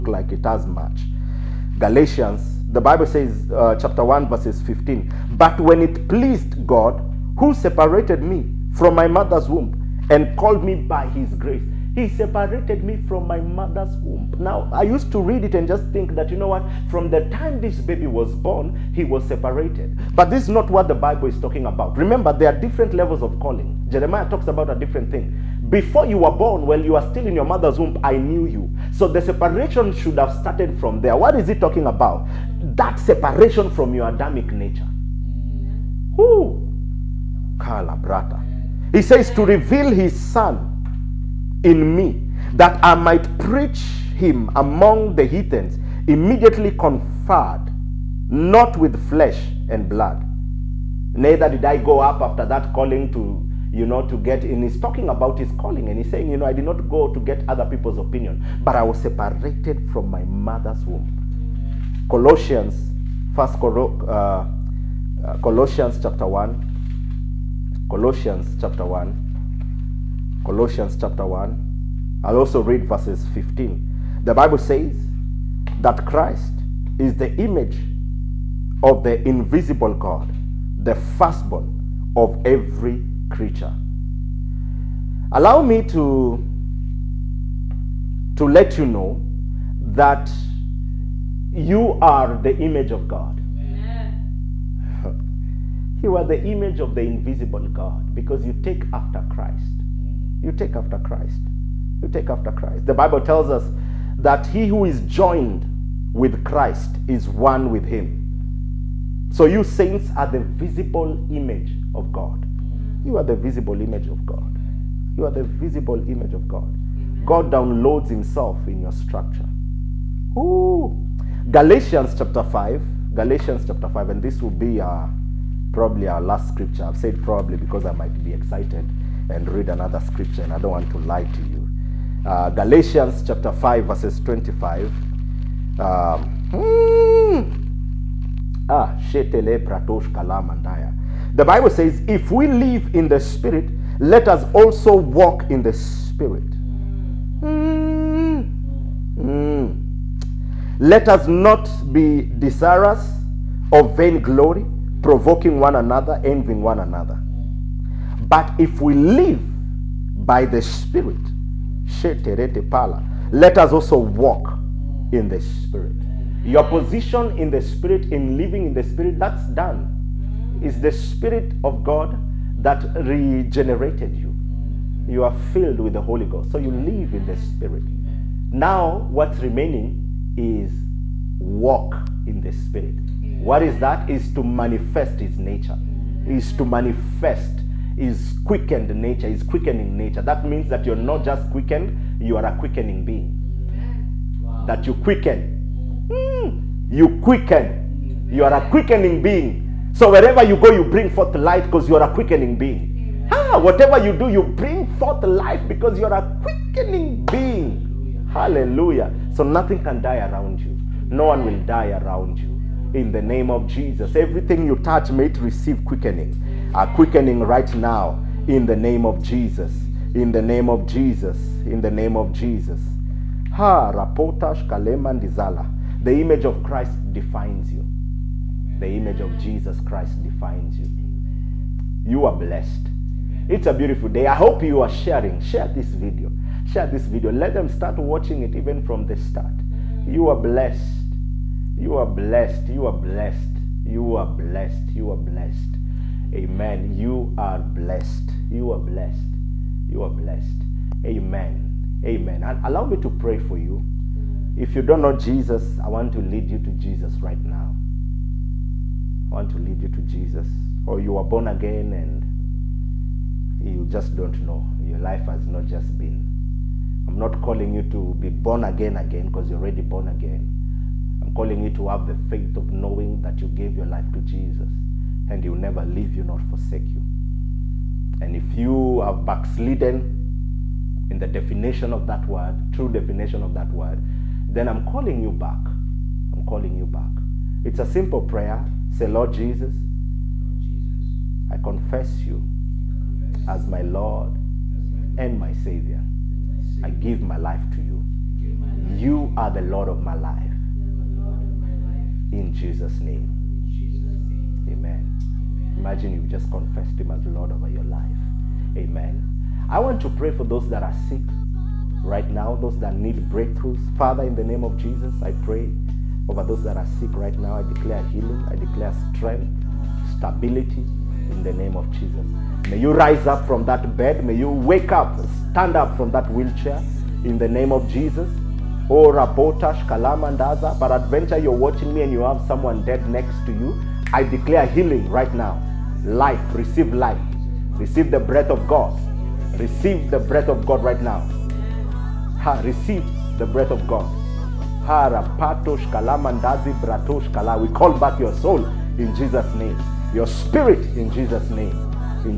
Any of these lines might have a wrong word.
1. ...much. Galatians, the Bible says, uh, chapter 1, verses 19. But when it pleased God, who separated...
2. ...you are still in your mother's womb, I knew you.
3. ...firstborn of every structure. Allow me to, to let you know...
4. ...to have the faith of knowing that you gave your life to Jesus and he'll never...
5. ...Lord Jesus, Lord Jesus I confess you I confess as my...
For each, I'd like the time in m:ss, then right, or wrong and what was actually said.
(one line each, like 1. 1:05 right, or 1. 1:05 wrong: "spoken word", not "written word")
1. 0:00 wrong: "15", not "19"
2. 0:26 right
3. 1:20 wrong: "creature", not "structure"
4. 4:31 right
5. 4:49 right.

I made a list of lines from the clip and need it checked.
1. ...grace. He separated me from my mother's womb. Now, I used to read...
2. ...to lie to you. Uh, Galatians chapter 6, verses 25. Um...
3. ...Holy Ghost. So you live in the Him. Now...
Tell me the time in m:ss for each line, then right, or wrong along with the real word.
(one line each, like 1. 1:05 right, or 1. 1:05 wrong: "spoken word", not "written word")
1. 0:11 right
2. 2:10 wrong: "5", not "6"
3. 2:56 wrong: "Spirit", not "Him".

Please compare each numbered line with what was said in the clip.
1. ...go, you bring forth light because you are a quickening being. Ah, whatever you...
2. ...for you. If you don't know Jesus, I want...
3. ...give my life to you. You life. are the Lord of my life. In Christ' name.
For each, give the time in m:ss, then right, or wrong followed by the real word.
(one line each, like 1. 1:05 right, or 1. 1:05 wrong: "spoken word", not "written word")
1. 3:20 right
2. 4:13 right
3. 4:56 wrong: "Jesus", not "Christ".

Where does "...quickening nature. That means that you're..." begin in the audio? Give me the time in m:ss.
3:09.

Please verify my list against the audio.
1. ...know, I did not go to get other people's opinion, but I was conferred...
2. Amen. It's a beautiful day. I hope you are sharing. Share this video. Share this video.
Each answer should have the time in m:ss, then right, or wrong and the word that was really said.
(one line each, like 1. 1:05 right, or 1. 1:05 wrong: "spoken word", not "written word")
1. 0:56 wrong: "separated", not "conferred"
2. 3:53 right.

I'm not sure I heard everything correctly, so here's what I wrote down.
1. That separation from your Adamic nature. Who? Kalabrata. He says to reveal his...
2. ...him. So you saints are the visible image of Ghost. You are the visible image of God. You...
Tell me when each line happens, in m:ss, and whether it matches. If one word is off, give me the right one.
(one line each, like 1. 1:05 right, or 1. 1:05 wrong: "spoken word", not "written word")
1. 0:32 right
2. 1:47 wrong: "God", not "Ghost".